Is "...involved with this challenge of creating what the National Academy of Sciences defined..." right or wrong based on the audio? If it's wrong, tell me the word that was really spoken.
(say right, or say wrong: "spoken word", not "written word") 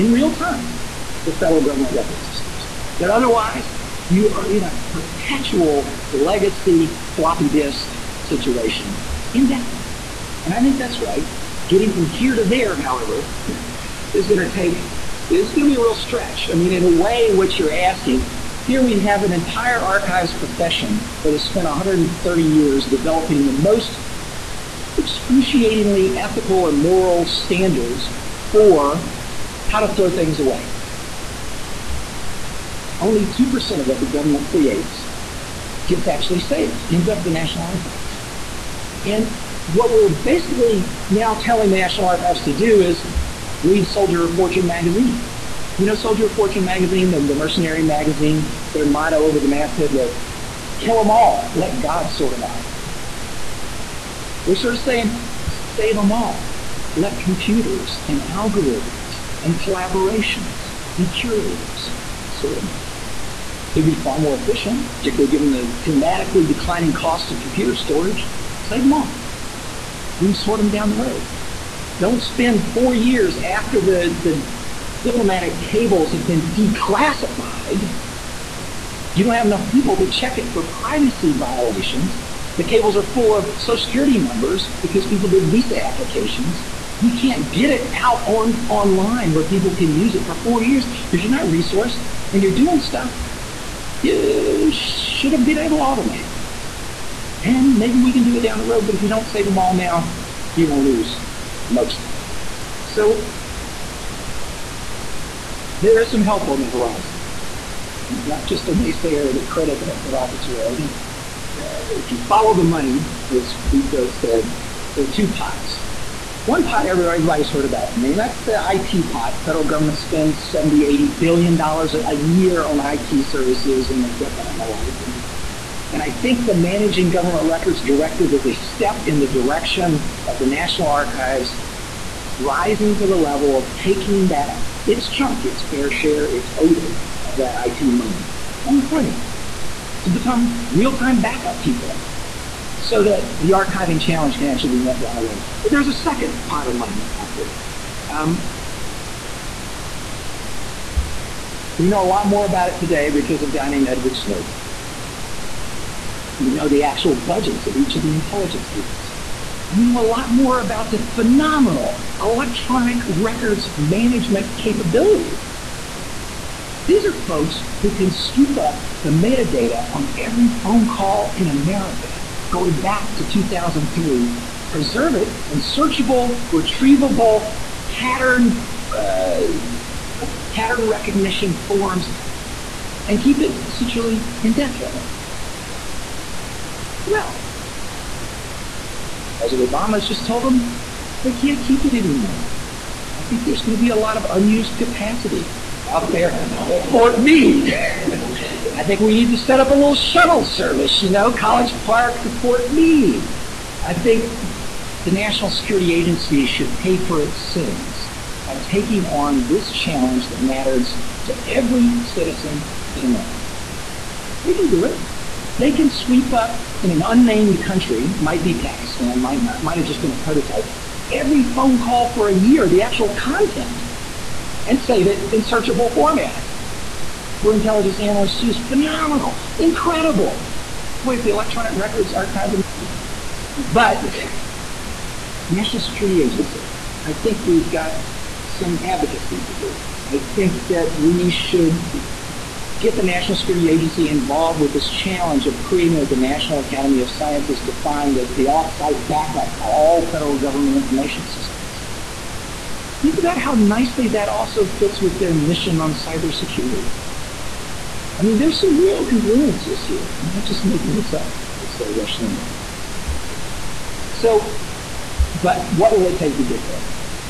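right.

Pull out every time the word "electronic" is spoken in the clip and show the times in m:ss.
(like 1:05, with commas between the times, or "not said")
2:42, 3:51.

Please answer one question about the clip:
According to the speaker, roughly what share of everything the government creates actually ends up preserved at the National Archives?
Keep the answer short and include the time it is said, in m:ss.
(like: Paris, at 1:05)
2%, at 0:33.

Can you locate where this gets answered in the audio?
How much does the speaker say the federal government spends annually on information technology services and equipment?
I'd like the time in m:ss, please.
2:00.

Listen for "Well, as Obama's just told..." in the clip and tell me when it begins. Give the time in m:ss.
3:07.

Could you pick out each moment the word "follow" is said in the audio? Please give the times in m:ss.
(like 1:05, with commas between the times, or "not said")
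1:52.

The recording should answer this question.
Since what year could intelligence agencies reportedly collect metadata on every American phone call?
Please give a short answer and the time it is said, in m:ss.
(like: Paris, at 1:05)
2003, at 2:53.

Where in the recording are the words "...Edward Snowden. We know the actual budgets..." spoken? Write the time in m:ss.
2:33.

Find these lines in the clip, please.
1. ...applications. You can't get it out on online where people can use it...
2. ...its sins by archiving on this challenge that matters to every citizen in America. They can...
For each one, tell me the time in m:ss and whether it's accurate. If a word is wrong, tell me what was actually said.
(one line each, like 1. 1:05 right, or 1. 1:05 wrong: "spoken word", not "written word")
1. 1:25 right
2. 3:27 wrong: "taking", not "archiving".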